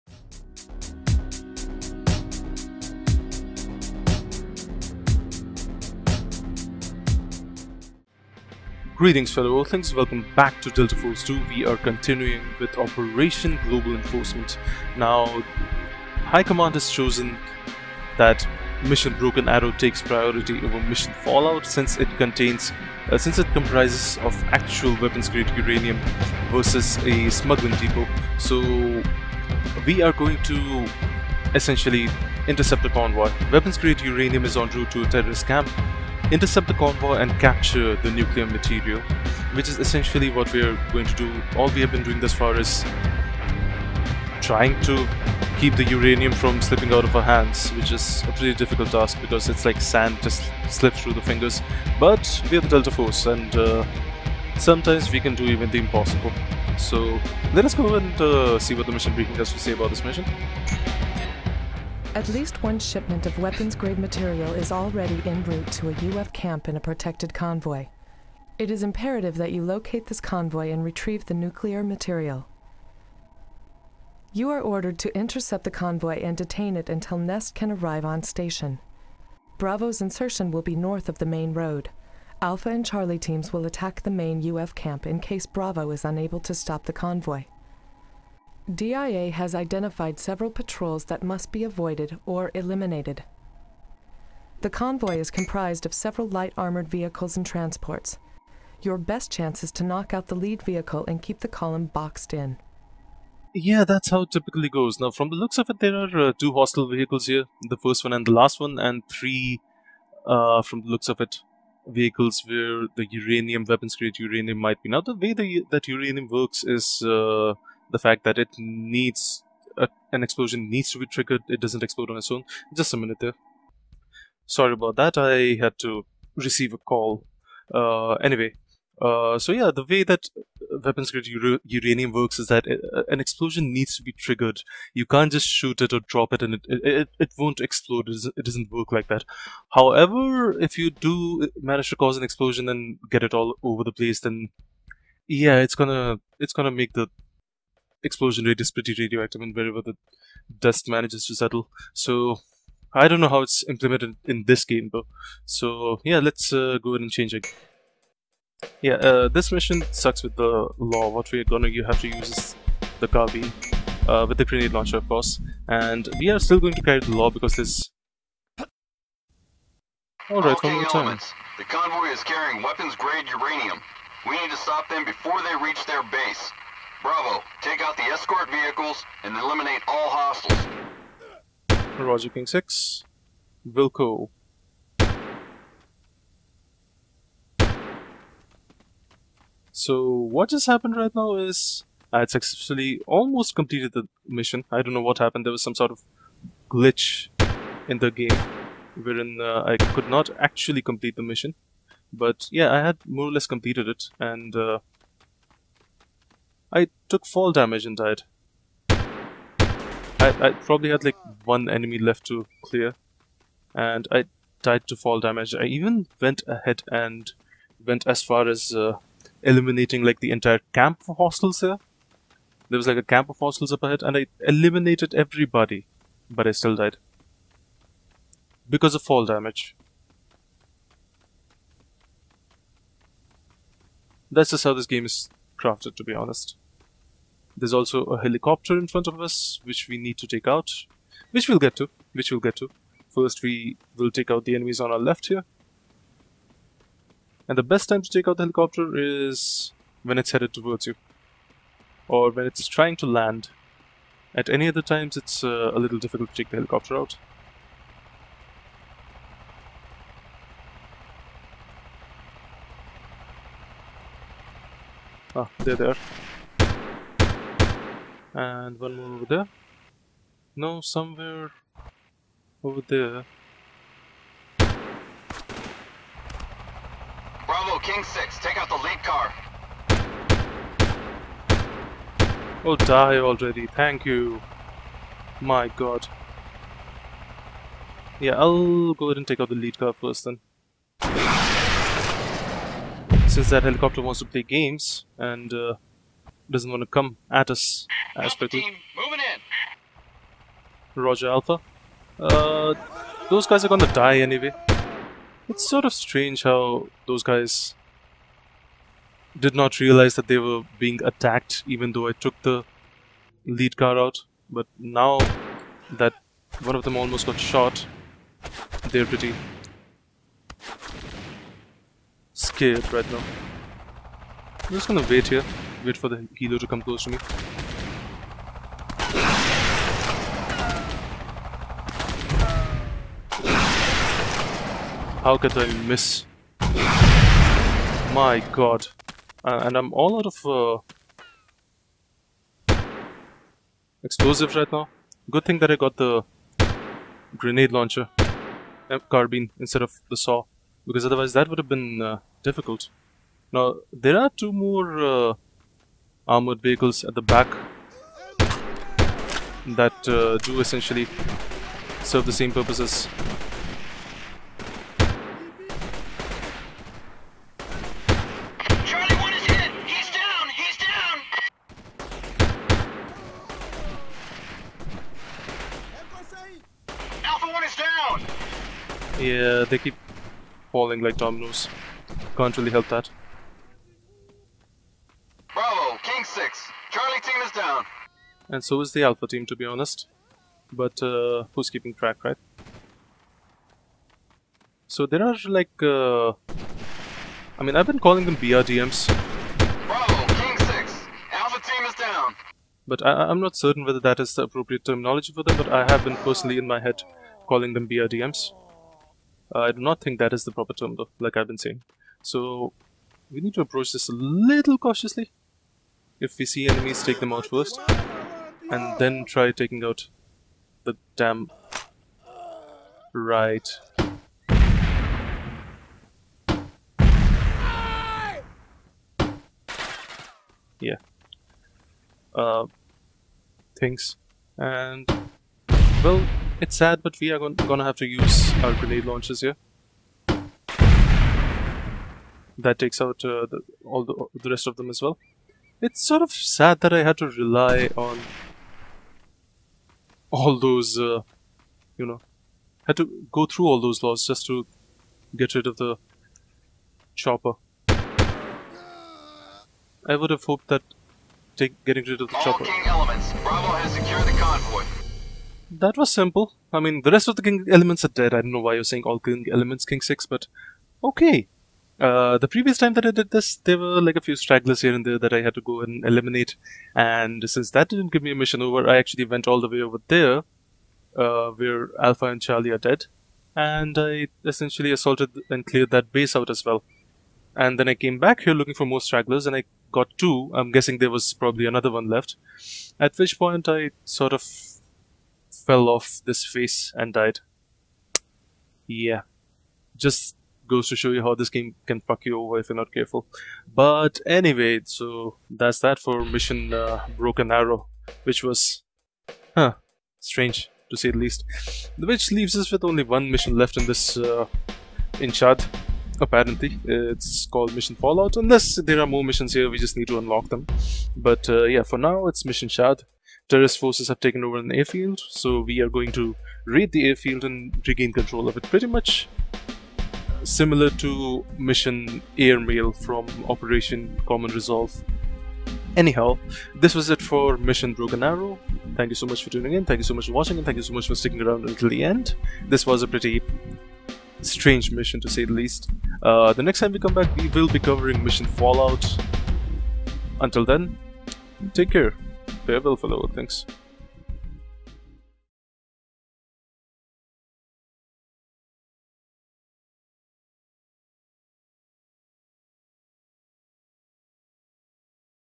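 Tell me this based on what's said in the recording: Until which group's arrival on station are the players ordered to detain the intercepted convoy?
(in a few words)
Nest.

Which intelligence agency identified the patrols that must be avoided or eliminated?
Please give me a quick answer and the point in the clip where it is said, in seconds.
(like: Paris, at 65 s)
DIA, at 88 s.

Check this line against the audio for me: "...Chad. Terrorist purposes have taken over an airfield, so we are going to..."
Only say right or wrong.
wrong.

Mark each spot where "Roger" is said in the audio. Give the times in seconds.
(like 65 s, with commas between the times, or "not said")
181 s, 300 s.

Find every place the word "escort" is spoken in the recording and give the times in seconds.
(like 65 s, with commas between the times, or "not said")
178 s.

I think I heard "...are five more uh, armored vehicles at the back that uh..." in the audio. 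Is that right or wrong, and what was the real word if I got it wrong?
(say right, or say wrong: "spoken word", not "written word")
wrong: "two", not "five".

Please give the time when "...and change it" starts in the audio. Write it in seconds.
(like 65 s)
157 s.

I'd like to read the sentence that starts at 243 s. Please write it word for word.
First, we will take out the enemies on our left here.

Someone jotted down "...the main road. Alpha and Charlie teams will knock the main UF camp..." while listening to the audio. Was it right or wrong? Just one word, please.
wrong.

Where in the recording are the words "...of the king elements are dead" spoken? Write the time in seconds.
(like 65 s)
467 s.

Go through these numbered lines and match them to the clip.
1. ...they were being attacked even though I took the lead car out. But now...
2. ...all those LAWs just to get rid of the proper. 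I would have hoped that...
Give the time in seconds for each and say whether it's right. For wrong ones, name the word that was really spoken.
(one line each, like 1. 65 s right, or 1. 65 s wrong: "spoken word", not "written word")
1. 310 s right
2. 453 s wrong: "chopper", not "proper".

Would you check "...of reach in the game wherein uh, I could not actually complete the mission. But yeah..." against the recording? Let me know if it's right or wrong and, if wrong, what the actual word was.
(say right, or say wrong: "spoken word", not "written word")
wrong: "glitch", not "reach".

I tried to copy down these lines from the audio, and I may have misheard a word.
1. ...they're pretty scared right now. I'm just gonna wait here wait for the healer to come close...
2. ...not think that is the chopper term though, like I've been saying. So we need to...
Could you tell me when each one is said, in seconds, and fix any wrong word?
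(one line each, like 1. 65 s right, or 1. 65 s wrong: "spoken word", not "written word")
1. 318 s right
2. 409 s wrong: "proper", not "chopper".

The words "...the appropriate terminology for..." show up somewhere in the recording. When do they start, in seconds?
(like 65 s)
404 s.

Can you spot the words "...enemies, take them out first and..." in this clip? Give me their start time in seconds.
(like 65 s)
416 s.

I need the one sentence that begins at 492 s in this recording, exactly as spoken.
At which point, I sort of fell off this face and died.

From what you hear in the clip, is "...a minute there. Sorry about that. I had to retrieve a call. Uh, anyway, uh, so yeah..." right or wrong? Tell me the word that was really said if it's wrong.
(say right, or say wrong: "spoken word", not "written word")
wrong: "receive", not "retrieve".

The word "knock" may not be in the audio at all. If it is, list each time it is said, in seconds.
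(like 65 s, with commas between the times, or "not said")
99 s.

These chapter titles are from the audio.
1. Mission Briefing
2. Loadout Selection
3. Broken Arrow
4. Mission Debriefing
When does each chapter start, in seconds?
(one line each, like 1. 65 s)
1. 60 s
2. 157 s
3. 168 s
4. 506 s.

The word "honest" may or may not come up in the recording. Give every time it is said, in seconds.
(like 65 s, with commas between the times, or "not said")
236 s, 389 s.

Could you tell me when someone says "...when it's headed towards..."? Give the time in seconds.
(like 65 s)
250 s.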